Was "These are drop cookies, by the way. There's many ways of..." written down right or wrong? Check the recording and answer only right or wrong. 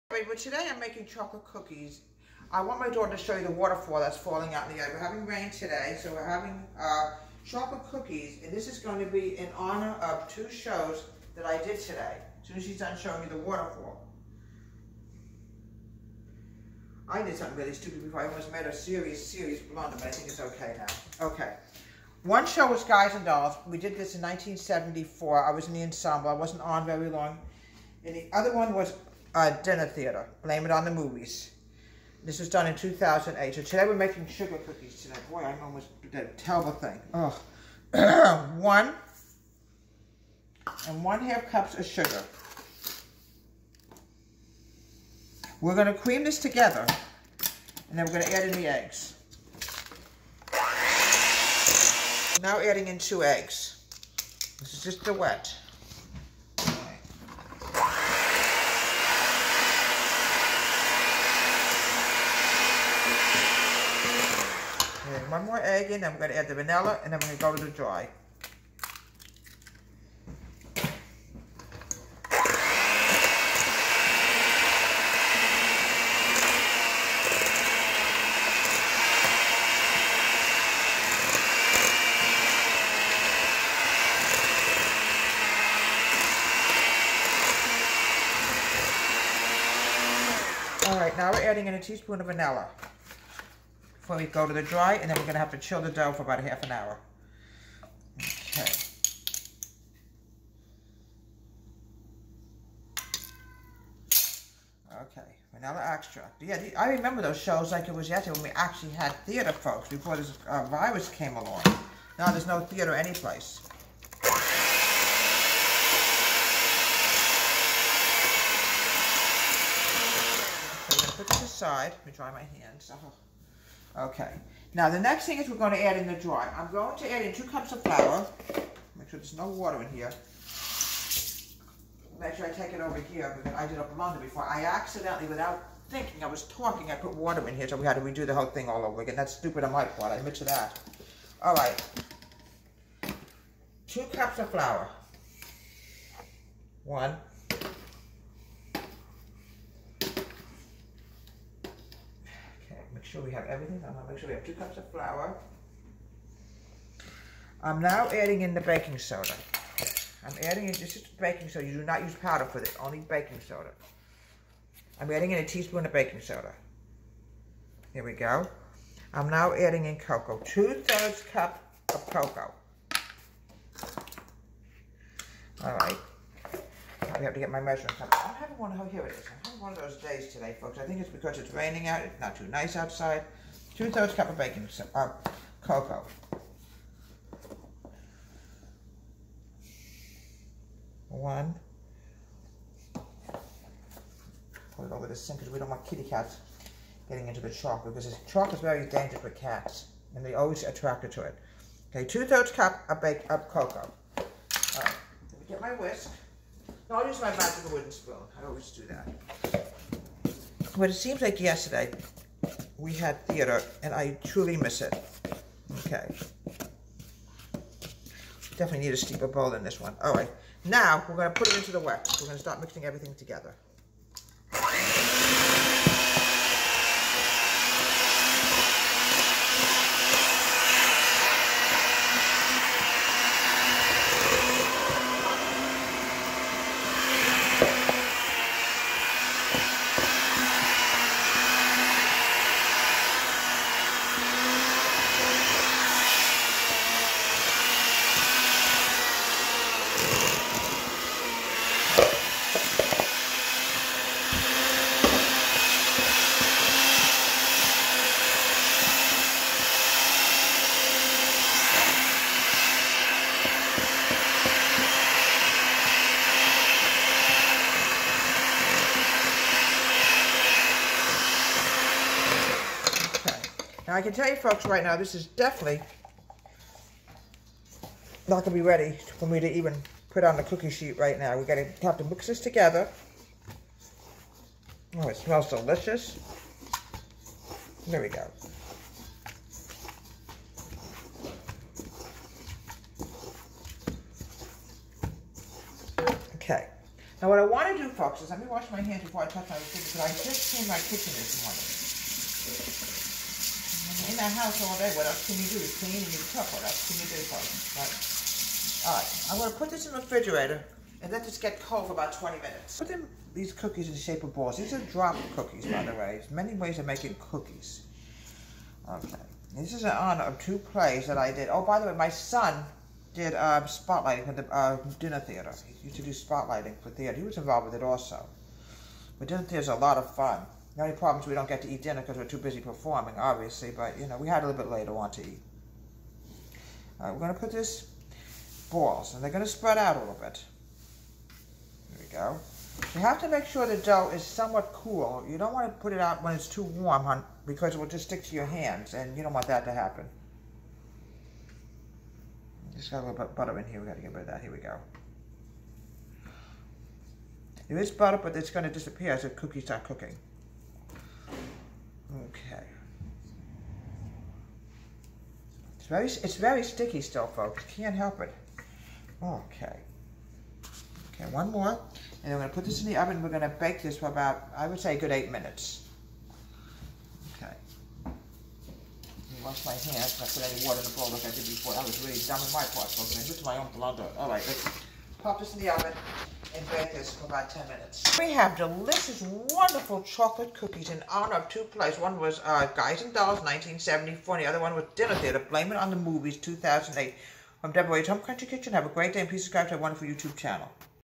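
right.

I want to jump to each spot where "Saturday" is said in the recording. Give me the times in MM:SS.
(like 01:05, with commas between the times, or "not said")
not said.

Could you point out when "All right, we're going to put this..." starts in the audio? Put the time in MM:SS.
05:36.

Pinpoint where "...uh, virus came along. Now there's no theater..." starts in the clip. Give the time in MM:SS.
01:50.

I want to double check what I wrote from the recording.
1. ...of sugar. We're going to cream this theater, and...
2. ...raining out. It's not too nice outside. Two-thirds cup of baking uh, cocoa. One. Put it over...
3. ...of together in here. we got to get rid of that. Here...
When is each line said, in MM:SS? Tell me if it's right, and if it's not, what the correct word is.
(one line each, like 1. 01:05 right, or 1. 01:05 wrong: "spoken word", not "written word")
1. 00:41 wrong: "together", not "theater"
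2. 03:01 right
3. 05:53 wrong: "butter", not "together".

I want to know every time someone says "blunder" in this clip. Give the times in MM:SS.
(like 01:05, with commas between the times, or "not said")
00:19, 02:13, 06:23.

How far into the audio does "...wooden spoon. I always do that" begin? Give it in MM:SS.
03:27.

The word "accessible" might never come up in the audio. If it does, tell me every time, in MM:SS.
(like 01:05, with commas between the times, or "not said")
not said.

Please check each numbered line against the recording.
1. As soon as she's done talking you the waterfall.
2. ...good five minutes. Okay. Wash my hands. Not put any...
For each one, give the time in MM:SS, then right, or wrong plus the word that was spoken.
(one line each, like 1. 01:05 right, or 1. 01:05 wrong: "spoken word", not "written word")
1. 00:12 wrong: "showing", not "talking"
2. 06:14 wrong: "eight", not "five".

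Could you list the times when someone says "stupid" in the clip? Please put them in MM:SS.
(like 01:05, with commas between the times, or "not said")
00:17, 02:19.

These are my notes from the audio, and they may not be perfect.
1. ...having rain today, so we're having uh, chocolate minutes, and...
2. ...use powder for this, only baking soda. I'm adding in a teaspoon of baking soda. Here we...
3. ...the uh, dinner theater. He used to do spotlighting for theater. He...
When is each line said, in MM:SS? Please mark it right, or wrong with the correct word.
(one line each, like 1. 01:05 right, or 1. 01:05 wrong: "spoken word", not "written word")
1. 00:04 wrong: "cookies", not "minutes"
2. 02:42 right
3. 05:24 right.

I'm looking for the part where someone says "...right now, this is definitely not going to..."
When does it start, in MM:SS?
04:34.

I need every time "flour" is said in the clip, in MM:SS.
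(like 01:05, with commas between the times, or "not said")
02:07, 02:24, 02:34.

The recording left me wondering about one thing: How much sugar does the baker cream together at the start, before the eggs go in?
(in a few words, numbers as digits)
1 1/2 cups.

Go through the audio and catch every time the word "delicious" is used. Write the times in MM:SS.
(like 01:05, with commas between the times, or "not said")
04:45, 06:28.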